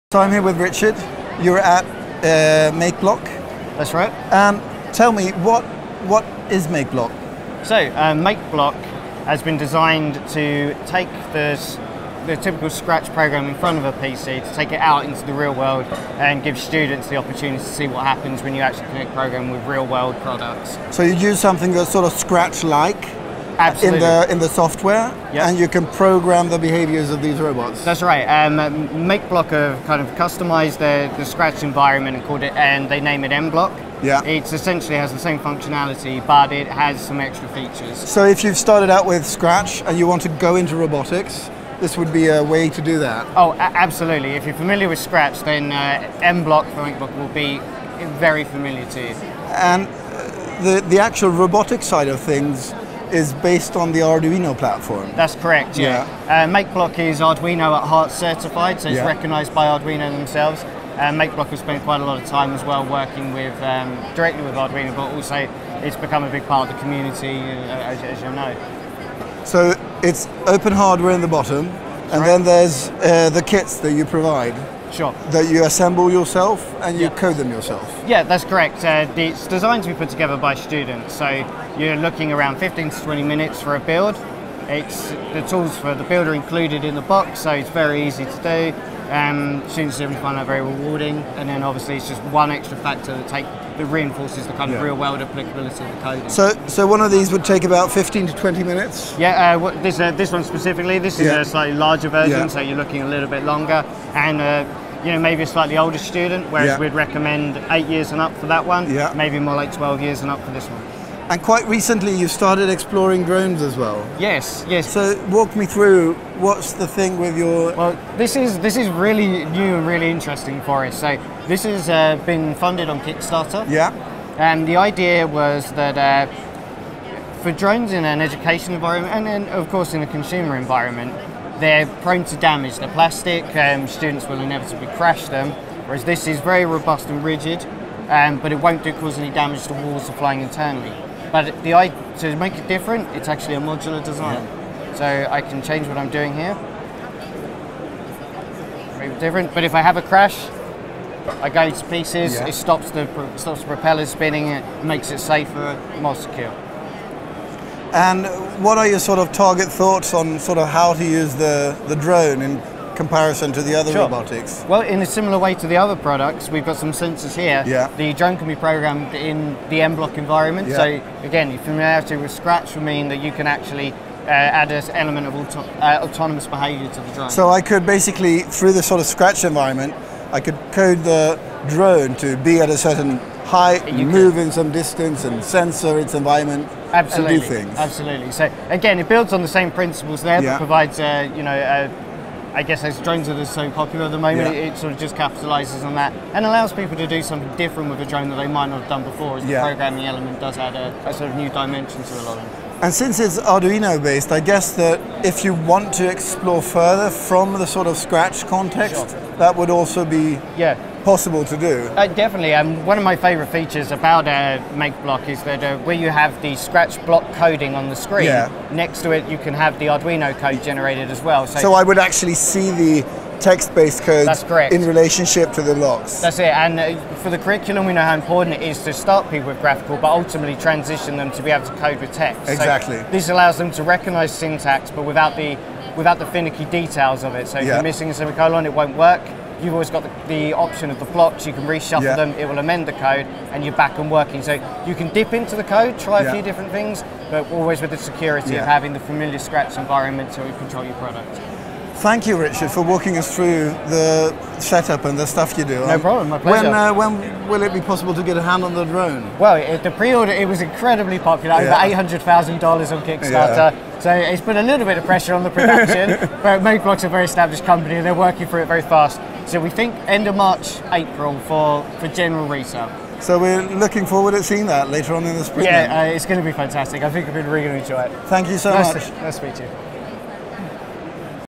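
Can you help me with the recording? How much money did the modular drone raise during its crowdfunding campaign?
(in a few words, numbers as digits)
Over $800,000.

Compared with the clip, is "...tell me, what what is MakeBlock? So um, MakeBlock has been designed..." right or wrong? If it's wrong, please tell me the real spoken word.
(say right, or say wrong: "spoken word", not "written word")
right.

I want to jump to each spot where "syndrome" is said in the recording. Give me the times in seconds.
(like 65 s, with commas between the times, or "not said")
not said.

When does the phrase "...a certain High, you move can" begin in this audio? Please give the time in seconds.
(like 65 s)
182 s.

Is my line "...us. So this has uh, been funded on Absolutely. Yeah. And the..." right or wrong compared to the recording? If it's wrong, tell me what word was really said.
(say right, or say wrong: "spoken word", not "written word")
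wrong: "Kickstarter", not "Absolutely".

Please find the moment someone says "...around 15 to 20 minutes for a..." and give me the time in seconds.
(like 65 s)
82 s.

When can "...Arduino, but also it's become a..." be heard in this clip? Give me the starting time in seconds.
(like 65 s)
64 s.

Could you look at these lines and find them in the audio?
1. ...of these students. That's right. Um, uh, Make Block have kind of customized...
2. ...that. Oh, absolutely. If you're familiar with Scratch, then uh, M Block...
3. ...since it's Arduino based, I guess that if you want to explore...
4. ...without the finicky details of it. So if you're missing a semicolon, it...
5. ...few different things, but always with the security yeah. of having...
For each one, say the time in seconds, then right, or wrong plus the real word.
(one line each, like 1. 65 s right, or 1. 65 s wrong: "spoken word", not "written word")
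1. 27 s wrong: "robots", not "students"
2. 42 s right
3. 202 s right
4. 235 s right
5. 246 s right.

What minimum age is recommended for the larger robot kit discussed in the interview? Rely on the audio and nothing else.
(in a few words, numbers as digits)
12 years.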